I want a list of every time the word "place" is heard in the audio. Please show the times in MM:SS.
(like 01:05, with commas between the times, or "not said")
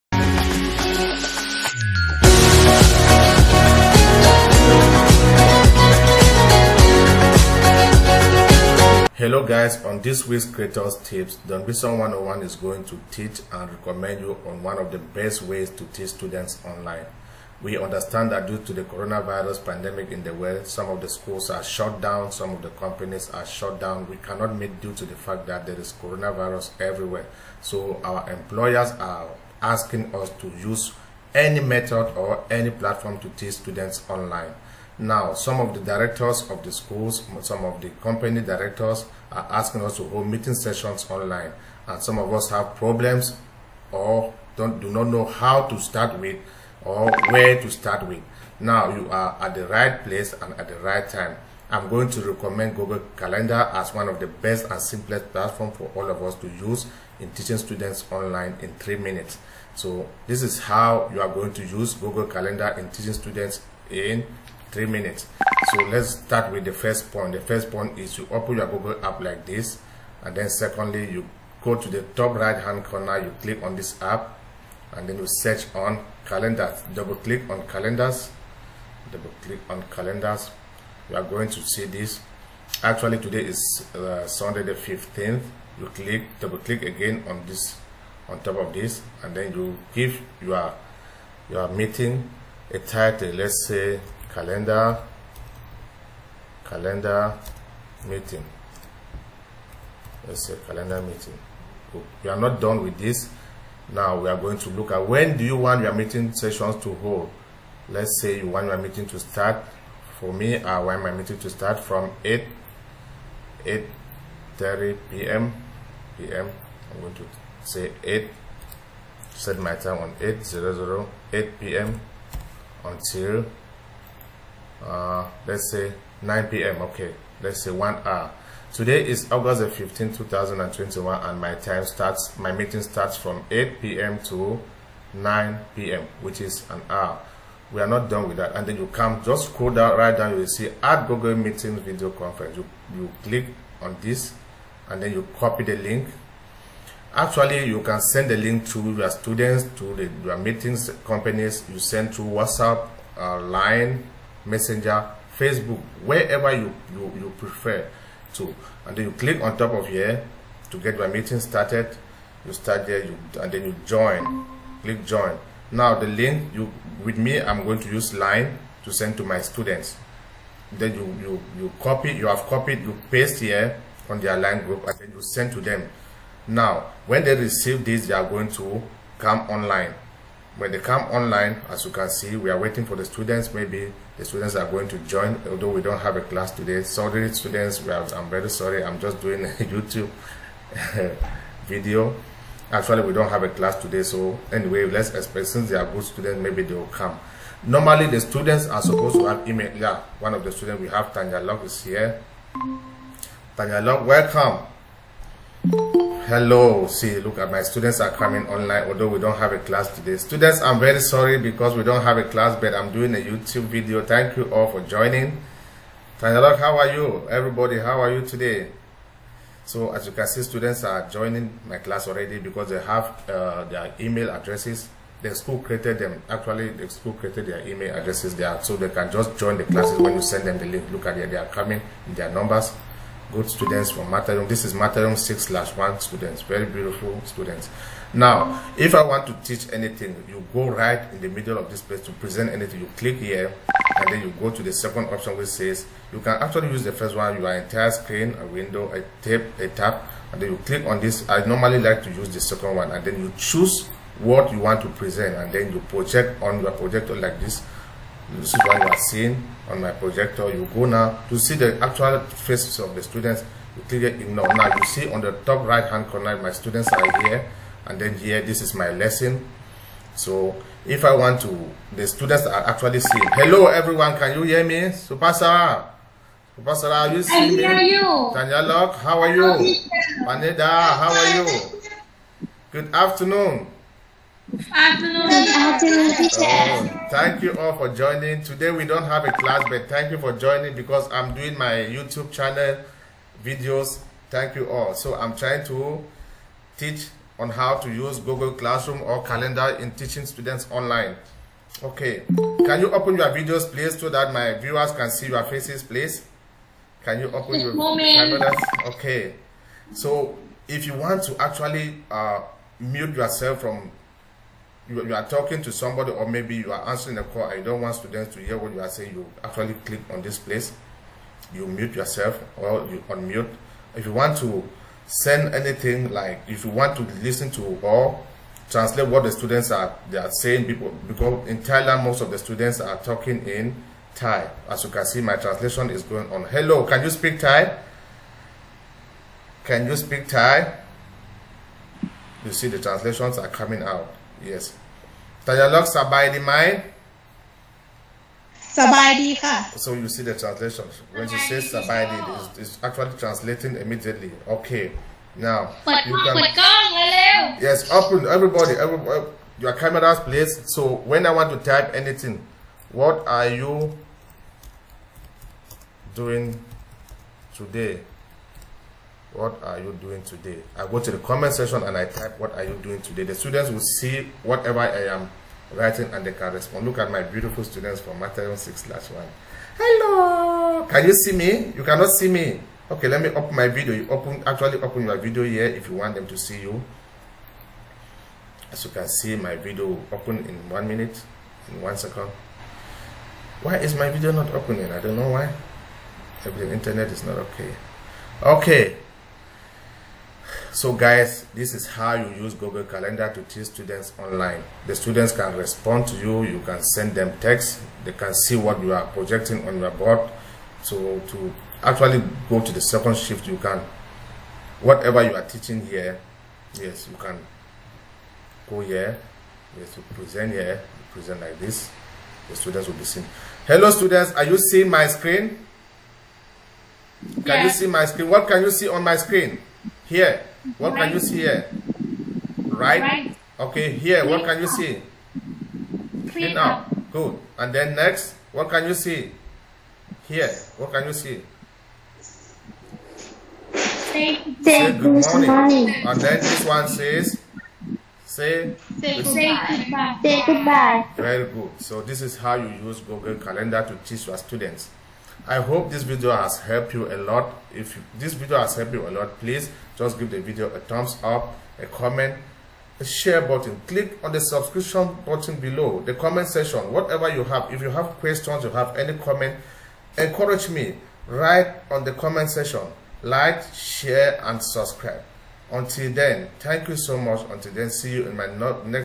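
00:50, 04:01, 05:20.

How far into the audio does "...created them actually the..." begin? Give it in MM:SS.
03:45.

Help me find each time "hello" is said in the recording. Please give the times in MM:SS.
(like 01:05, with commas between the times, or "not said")
00:09, 03:26, 04:33, 05:36, 06:19, 07:03.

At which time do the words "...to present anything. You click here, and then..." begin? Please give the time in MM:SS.
04:02.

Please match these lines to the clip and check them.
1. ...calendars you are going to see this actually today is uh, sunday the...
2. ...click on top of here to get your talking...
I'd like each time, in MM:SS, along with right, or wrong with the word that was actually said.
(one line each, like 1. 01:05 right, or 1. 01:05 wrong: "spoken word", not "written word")
1. 01:19 right
2. 02:39 wrong: "meeting", not "talking".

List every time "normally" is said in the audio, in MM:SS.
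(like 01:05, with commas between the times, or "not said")
03:17, 04:11.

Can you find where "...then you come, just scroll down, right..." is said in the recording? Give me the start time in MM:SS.
02:18.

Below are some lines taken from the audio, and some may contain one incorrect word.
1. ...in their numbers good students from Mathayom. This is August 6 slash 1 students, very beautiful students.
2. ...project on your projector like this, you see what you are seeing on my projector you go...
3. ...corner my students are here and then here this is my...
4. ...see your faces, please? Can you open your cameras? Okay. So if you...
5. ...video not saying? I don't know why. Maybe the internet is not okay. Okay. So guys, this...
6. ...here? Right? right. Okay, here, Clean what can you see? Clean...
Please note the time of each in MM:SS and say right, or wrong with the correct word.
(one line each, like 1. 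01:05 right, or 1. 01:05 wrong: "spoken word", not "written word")
1. 03:52 wrong: "Mathayom", not "August"
2. 04:15 right
3. 04:26 right
4. 05:05 right
5. 06:34 wrong: "opening", not "saying"
6. 07:11 right.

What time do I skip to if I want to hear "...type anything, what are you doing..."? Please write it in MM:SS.
06:01.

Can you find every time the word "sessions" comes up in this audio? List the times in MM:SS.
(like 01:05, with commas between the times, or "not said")
00:40, 01:46.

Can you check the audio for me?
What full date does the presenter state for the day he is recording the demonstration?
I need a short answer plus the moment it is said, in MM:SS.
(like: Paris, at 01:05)
August 15, 2021, at 02:09.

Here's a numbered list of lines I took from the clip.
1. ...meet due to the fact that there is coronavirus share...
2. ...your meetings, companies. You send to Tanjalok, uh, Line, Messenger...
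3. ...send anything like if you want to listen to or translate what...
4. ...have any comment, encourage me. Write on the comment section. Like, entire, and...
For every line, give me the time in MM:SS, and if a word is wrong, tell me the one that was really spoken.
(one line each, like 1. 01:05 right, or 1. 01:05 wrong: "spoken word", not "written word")
1. 00:24 wrong: "everywhere", not "share"
2. 02:30 wrong: "WhatsApp", not "Tanjalok"
3. 05:25 right
4. 07:48 wrong: "share", not "entire".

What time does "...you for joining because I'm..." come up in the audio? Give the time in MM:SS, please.
04:50.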